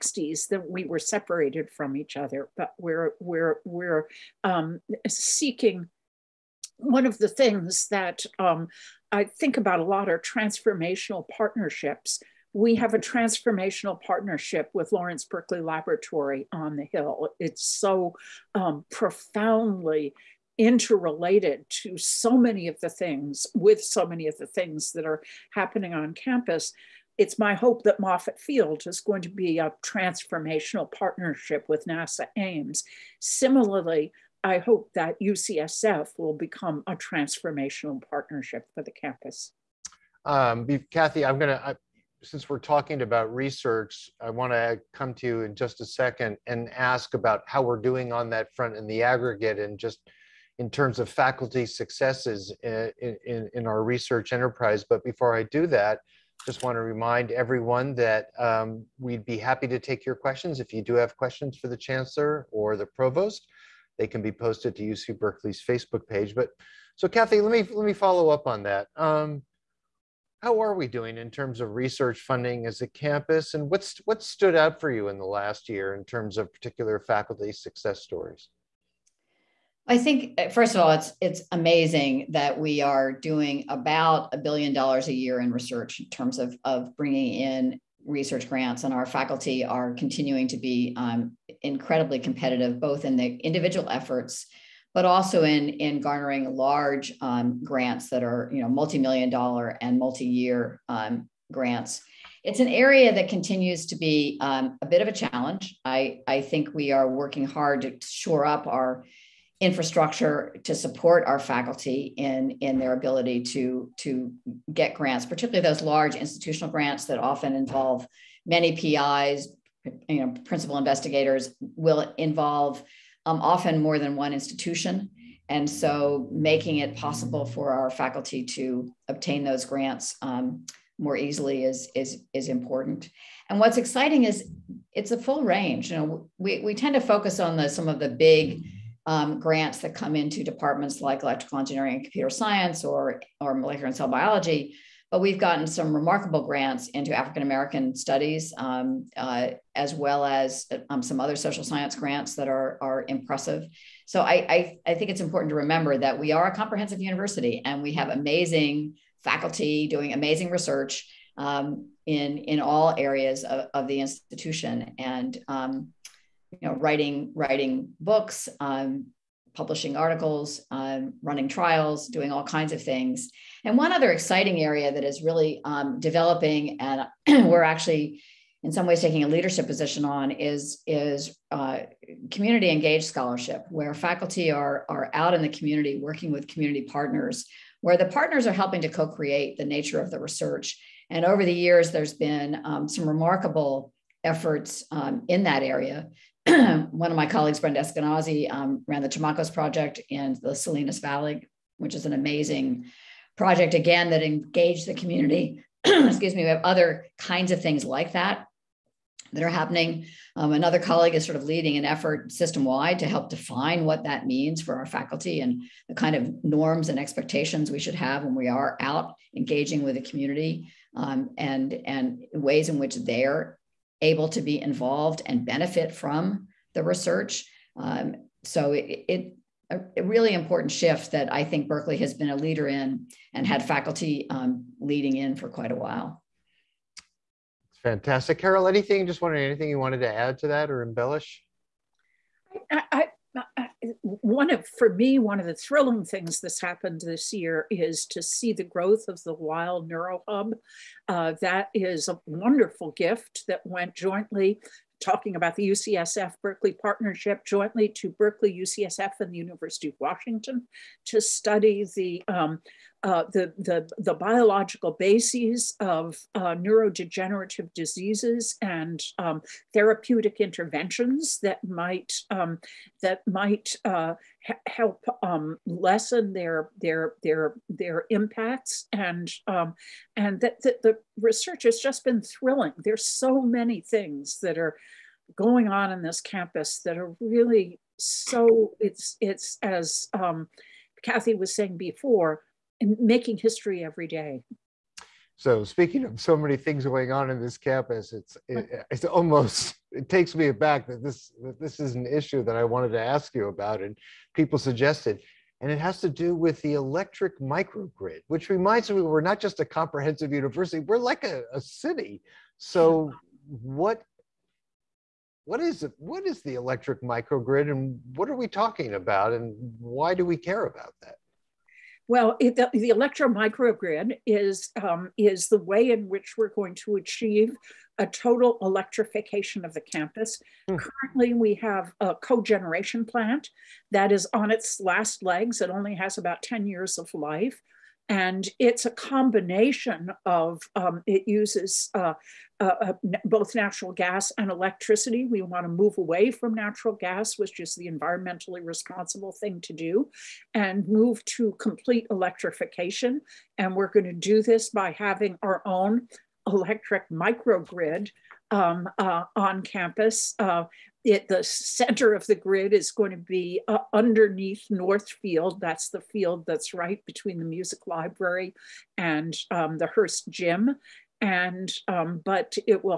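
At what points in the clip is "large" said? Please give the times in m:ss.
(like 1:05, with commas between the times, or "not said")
1:36, 1:55.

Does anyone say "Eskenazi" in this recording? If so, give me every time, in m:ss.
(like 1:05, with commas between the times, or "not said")
3:17.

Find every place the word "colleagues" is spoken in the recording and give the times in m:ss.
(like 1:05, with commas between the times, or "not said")
3:17, 3:30.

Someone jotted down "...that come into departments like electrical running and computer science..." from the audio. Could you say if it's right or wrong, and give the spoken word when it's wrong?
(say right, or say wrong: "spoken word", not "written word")
wrong: "engineering", not "running".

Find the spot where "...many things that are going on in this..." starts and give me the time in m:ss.
4:43.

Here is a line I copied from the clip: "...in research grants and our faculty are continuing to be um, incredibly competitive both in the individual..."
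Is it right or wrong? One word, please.
right.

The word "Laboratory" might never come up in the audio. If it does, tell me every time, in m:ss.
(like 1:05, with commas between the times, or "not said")
0:15.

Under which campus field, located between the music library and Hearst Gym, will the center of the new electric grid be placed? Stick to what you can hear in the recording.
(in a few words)
Northfield.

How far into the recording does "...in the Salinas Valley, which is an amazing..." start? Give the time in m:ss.
3:20.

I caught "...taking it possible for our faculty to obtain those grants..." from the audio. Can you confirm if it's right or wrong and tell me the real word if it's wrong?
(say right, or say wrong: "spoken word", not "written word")
wrong: "making", not "taking".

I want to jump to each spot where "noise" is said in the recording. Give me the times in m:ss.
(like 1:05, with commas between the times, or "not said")
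not said.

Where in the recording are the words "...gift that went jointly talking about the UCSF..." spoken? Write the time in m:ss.
4:12.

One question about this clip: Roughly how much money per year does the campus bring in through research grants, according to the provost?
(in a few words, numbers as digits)
1 billion dollars.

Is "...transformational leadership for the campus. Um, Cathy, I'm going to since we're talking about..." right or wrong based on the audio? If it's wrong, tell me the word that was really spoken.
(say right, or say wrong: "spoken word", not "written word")
wrong: "partnership", not "leadership".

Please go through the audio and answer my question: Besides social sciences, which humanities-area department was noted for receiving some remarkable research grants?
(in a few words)
African American studies.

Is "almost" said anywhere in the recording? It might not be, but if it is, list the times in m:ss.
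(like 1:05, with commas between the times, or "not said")
4:59.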